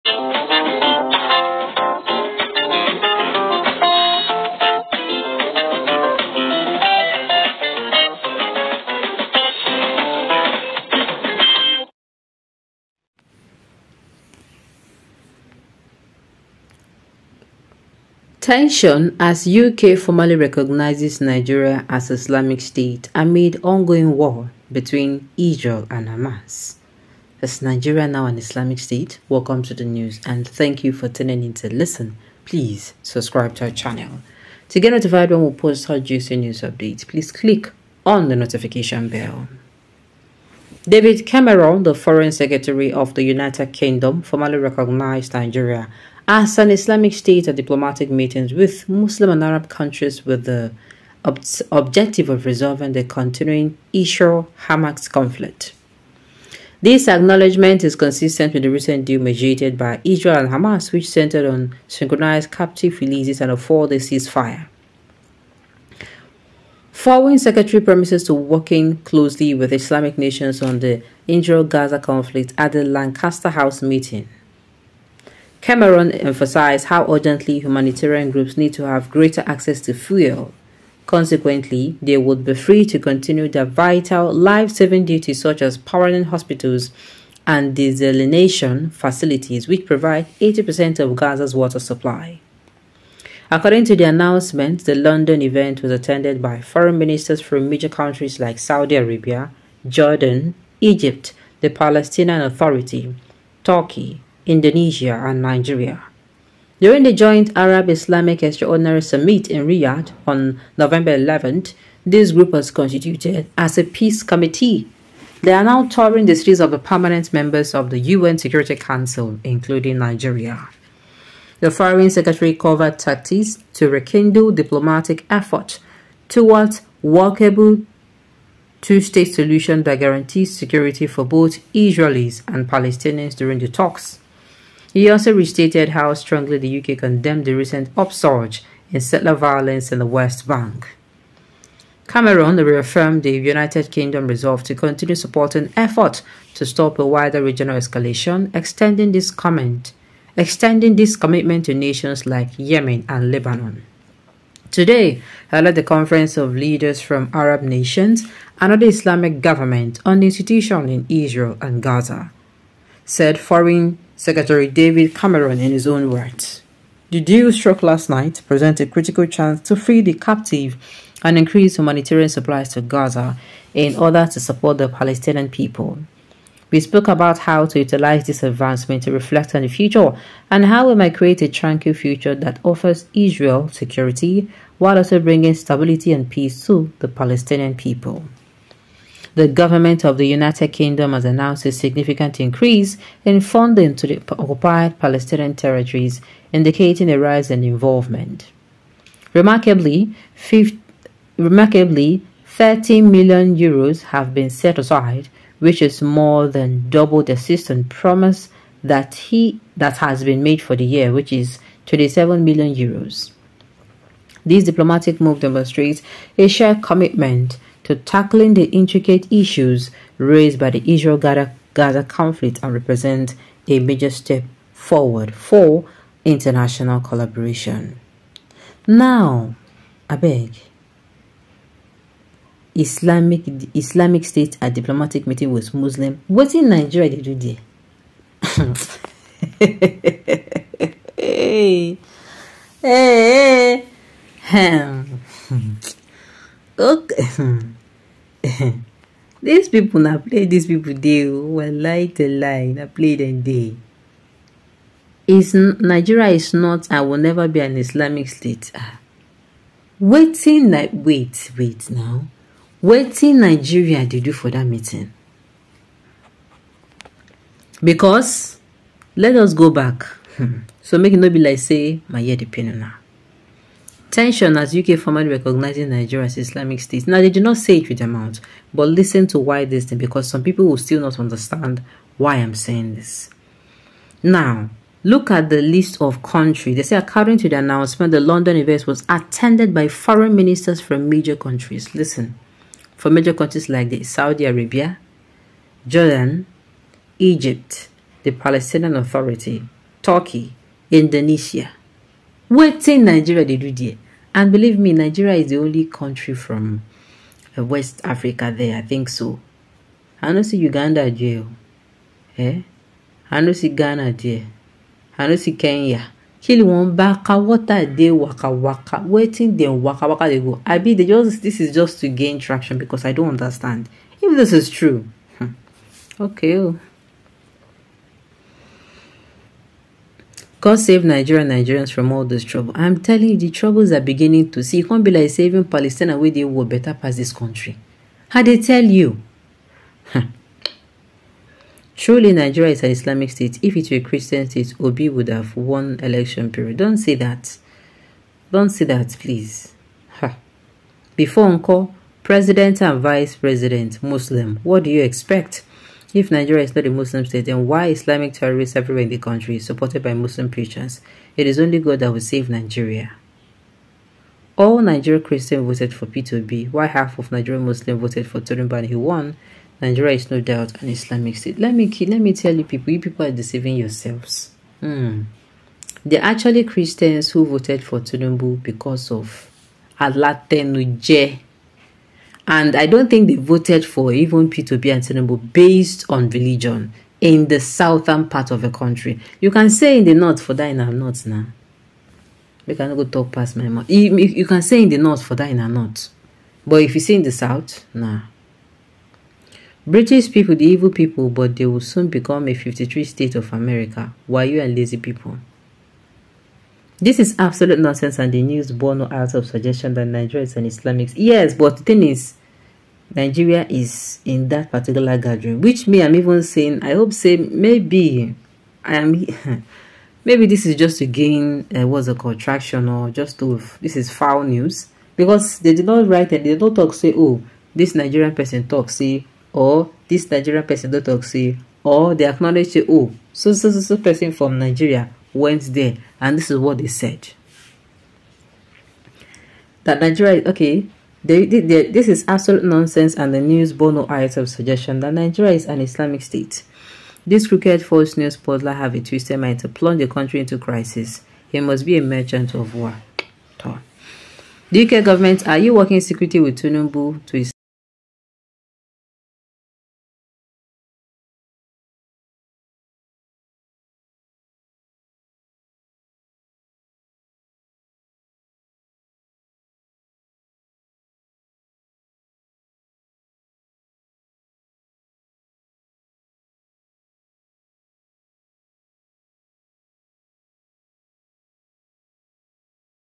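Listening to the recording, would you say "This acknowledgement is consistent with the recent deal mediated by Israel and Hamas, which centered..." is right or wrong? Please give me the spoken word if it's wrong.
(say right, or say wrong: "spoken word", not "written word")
right.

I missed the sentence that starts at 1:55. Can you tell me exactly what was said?
They are now touring the cities of the permanent members of the UN Security Council, including Nigeria.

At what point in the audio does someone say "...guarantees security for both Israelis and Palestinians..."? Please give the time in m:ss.
2:09.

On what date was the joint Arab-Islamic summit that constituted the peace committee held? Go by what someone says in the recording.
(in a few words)
November 11.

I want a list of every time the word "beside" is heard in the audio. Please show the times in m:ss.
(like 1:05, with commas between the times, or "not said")
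not said.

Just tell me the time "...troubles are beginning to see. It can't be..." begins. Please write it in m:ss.
5:33.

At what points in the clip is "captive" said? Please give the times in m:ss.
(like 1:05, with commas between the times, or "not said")
1:02, 2:50.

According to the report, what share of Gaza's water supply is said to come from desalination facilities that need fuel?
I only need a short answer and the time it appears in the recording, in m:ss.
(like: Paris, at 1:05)
80%, at 1:30.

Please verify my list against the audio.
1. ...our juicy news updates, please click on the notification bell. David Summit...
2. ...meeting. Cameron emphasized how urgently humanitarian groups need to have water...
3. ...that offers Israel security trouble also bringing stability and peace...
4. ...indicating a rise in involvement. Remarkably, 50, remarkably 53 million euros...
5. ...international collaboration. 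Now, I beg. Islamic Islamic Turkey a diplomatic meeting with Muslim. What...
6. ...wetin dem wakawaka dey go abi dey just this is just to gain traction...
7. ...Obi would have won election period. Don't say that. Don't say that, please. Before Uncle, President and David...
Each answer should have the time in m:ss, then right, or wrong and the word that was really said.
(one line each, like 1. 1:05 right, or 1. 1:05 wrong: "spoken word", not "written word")
1. 0:35 wrong: "Cameron", not "Summit"
2. 1:13 wrong: "greater", not "water"
3. 3:02 wrong: "while", not "trouble"
4. 3:16 wrong: "13", not "53"
5. 3:46 wrong: "State", not "Turkey"
6. 5:19 right
7. 5:44 wrong: "Vice", not "David".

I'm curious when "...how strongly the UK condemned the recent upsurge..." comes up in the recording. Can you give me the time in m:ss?
2:15.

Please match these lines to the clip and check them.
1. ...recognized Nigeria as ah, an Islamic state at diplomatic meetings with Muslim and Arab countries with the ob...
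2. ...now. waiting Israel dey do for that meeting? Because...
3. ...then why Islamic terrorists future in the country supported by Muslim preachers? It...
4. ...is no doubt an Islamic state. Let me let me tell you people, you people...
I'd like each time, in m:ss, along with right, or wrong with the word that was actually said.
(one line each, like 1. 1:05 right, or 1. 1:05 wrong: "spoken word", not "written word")
1. 0:44 right
2. 4:21 wrong: "Nigeria", not "Israel"
3. 5:57 wrong: "everywhere", not "future"
4. 6:10 right.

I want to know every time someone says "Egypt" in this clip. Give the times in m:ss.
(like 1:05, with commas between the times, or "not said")
1:40, 4:57.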